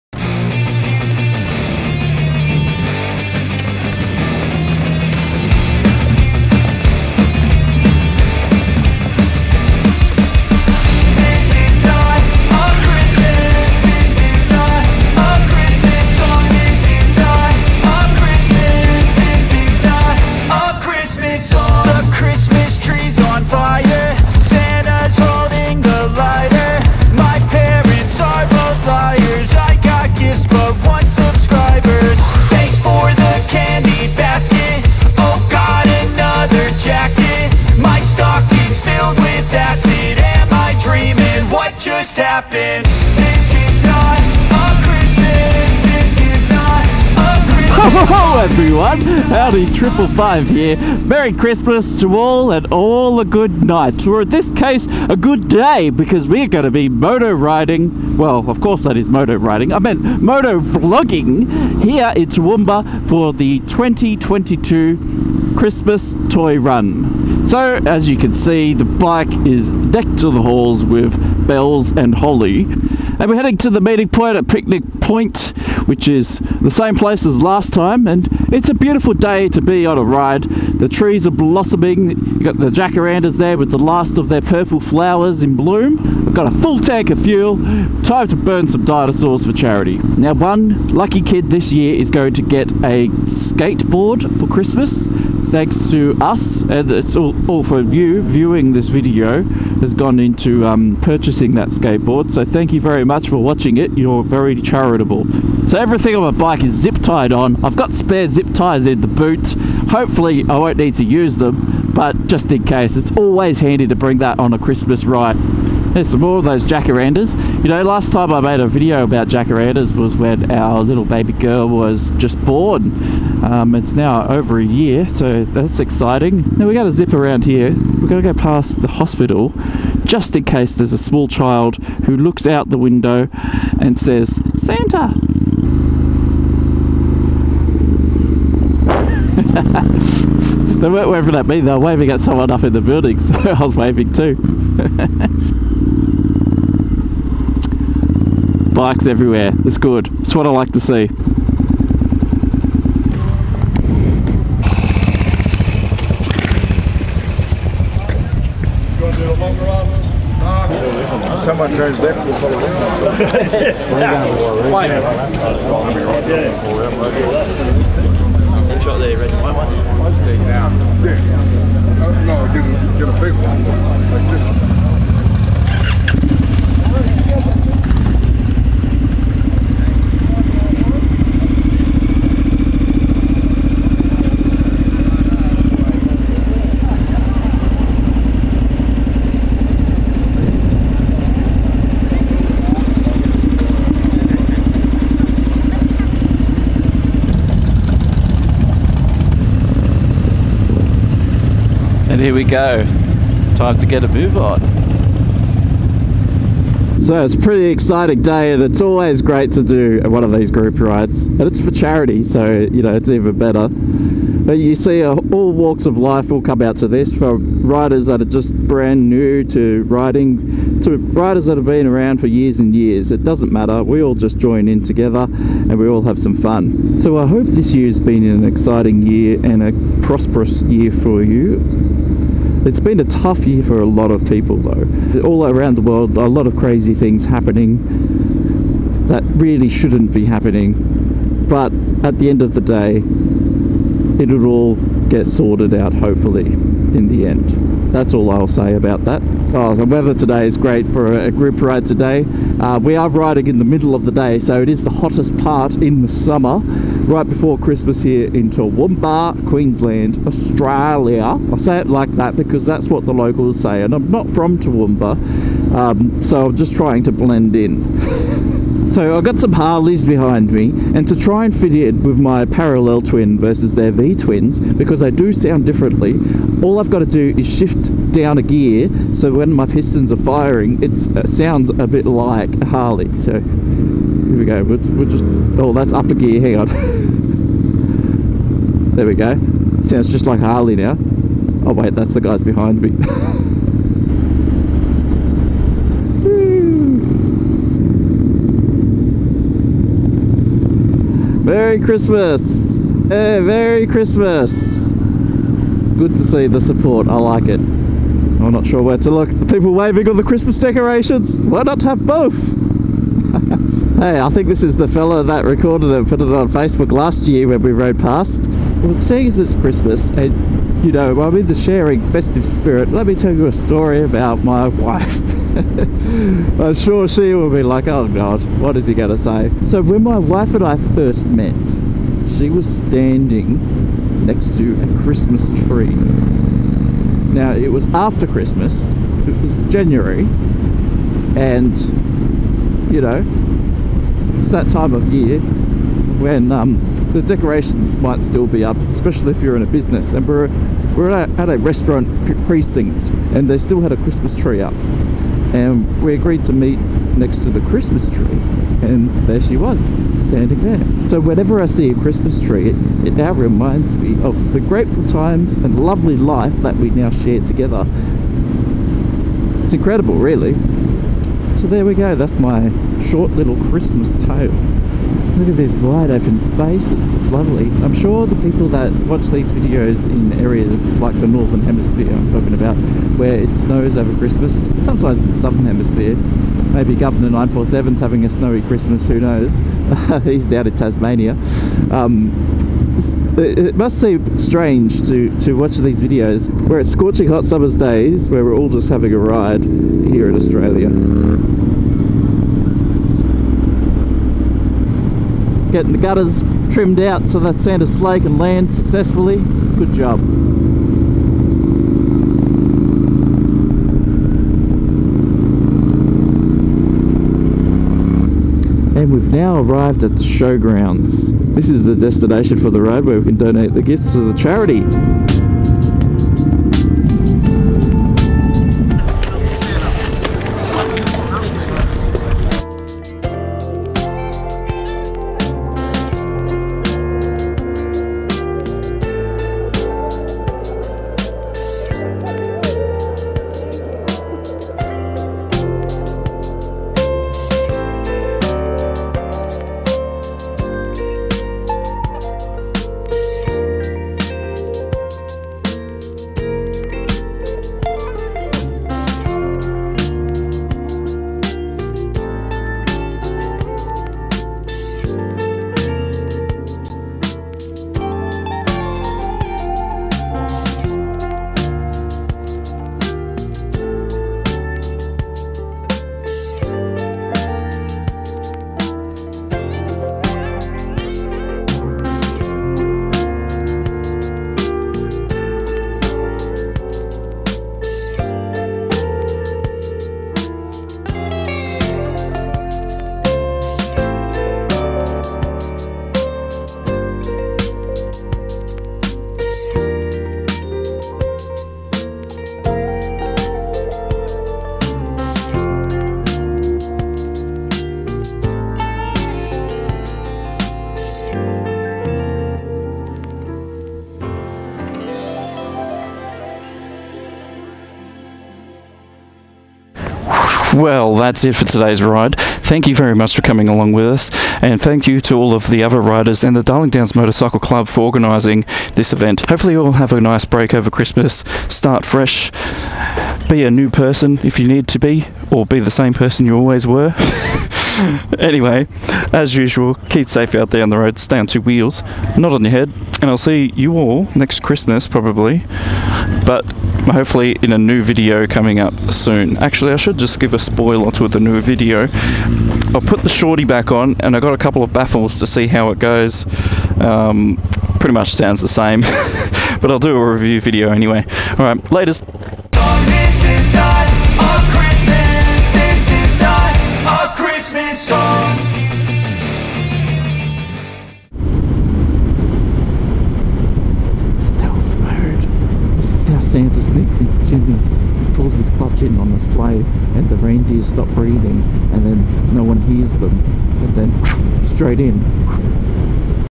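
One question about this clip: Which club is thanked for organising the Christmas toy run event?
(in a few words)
Darling Downs Motorcycle Club.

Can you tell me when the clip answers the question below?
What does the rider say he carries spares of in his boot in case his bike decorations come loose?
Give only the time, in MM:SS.
01:48.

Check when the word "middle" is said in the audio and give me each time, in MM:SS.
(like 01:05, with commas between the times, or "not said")
04:13.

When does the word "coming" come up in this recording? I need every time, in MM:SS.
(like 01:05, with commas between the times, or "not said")
08:43, 09:08.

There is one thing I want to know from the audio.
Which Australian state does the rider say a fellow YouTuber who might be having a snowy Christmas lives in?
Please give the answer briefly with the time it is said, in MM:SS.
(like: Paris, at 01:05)
Tasmania, at 06:30.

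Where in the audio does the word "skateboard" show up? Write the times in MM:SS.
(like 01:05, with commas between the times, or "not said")
01:33, 01:41.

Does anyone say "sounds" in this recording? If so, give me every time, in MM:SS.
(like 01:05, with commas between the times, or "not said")
04:35, 04:41, 04:49, 09:18.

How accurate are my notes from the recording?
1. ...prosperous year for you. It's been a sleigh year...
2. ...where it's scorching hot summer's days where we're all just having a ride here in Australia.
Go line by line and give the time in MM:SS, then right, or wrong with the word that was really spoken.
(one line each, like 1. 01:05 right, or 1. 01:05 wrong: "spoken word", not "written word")
1. 03:50 wrong: "tough", not "sleigh"
2. 06:36 right.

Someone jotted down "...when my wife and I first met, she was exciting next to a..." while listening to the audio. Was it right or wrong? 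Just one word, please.
wrong.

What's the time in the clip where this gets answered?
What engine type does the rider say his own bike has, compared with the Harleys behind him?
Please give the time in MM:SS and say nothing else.
04:32.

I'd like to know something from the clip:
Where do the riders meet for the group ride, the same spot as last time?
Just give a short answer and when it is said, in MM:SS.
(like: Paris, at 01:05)
Picnic Point, at 01:14.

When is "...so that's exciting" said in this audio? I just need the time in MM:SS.
02:05.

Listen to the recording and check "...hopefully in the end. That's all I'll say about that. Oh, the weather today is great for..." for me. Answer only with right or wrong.
right.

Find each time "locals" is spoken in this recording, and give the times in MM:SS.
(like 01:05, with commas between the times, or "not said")
04:23.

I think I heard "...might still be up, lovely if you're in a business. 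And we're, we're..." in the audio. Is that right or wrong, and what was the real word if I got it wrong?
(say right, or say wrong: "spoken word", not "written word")
wrong: "especially", not "lovely".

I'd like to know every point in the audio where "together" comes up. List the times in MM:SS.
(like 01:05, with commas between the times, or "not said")
03:44, 06:07.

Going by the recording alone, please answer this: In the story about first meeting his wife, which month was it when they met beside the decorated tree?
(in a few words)
January.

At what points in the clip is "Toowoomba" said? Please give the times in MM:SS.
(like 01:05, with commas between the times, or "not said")
01:02, 04:18, 04:24.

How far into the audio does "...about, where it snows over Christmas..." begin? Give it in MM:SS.
06:22.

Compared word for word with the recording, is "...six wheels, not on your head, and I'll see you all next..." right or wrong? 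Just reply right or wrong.
wrong.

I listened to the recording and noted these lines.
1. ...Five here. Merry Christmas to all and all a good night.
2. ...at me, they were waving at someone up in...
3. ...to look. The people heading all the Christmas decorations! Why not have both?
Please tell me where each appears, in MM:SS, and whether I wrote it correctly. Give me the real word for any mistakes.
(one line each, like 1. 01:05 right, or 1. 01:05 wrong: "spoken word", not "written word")
1. 00:50 right
2. 02:21 right
3. 05:08 wrong: "waving", not "heading".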